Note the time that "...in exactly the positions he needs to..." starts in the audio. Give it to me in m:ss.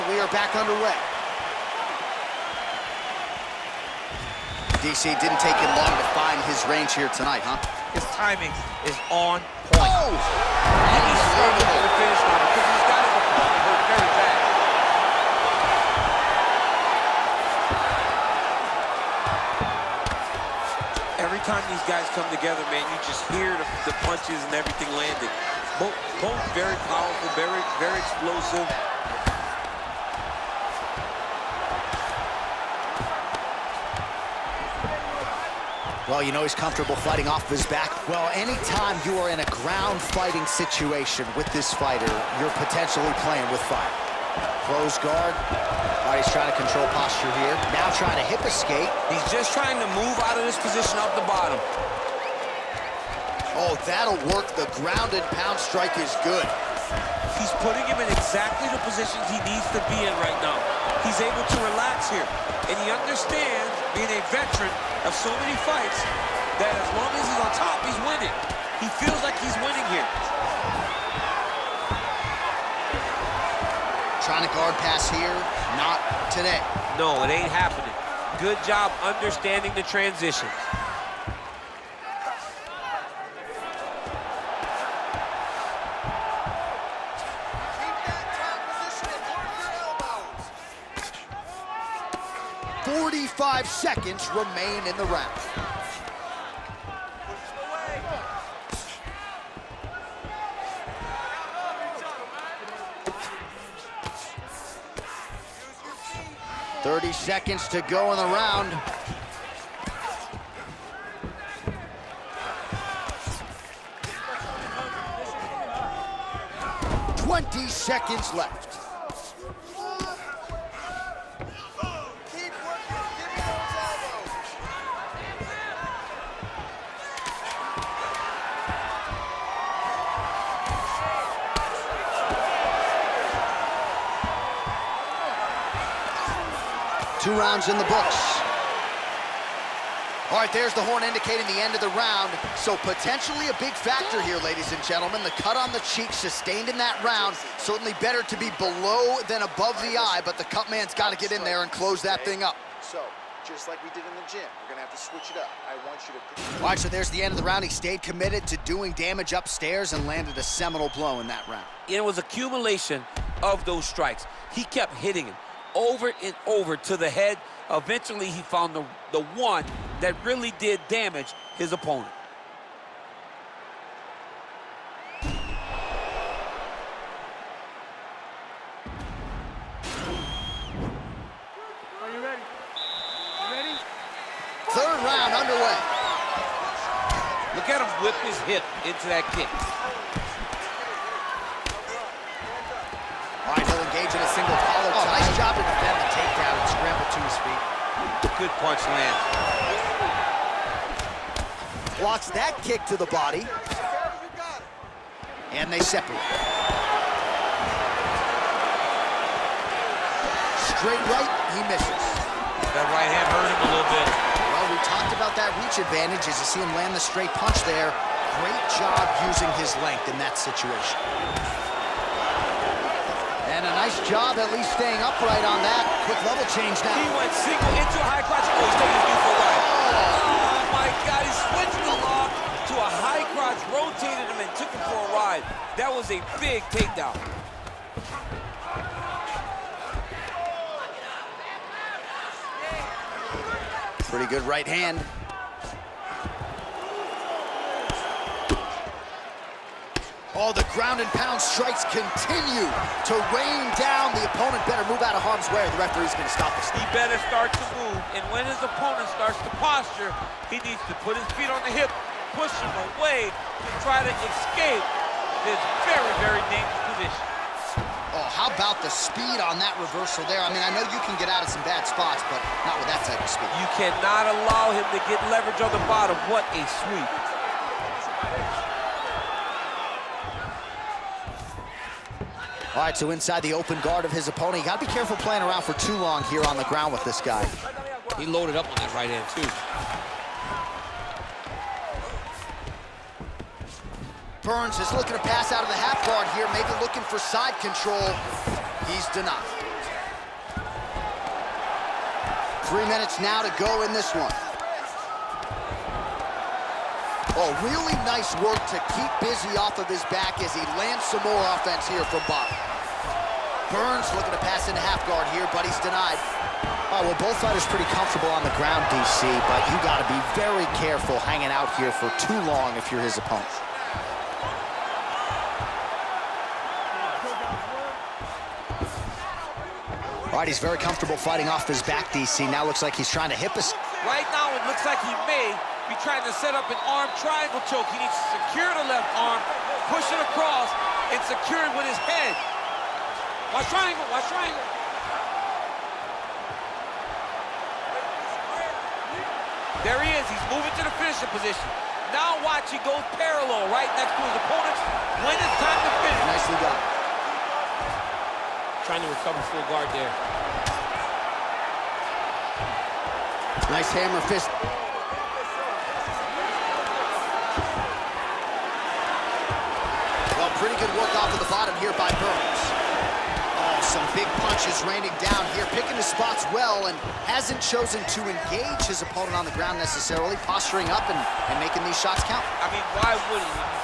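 0:58.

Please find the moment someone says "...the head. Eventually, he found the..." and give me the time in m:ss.
2:46.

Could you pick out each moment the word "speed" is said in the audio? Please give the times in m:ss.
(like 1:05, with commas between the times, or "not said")
4:28, 4:33.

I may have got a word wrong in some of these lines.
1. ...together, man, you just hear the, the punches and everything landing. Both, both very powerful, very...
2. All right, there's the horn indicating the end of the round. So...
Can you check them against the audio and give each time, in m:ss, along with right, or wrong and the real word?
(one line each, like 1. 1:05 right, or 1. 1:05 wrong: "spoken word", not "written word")
1. 0:22 right
2. 2:20 right.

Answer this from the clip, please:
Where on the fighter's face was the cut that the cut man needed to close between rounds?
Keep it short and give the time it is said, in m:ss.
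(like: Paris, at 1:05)
On the cheek, at 2:25.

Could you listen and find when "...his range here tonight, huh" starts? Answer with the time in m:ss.
0:06.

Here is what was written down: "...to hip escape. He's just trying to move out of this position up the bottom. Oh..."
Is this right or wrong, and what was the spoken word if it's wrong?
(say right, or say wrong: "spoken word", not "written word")
right.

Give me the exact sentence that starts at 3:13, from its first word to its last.
All right, he'll engage in a single collar Oh, nice job good punch lands.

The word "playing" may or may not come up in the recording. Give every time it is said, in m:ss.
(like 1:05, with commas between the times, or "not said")
0:43, 4:45.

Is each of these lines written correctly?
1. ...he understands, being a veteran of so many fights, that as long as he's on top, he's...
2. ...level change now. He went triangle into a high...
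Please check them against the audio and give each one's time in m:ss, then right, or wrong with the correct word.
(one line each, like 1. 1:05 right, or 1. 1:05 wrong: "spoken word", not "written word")
1. 1:02 right
2. 3:46 wrong: "single", not "triangle".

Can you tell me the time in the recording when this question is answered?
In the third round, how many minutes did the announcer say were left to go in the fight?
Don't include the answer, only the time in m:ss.
5:02.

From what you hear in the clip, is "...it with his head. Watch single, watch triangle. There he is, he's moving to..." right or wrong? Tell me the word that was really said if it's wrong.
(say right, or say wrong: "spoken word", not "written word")
wrong: "triangle", not "single".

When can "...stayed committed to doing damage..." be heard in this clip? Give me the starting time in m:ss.
2:37.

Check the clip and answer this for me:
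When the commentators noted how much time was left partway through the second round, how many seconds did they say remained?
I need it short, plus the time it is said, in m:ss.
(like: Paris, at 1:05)
45, at 1:32.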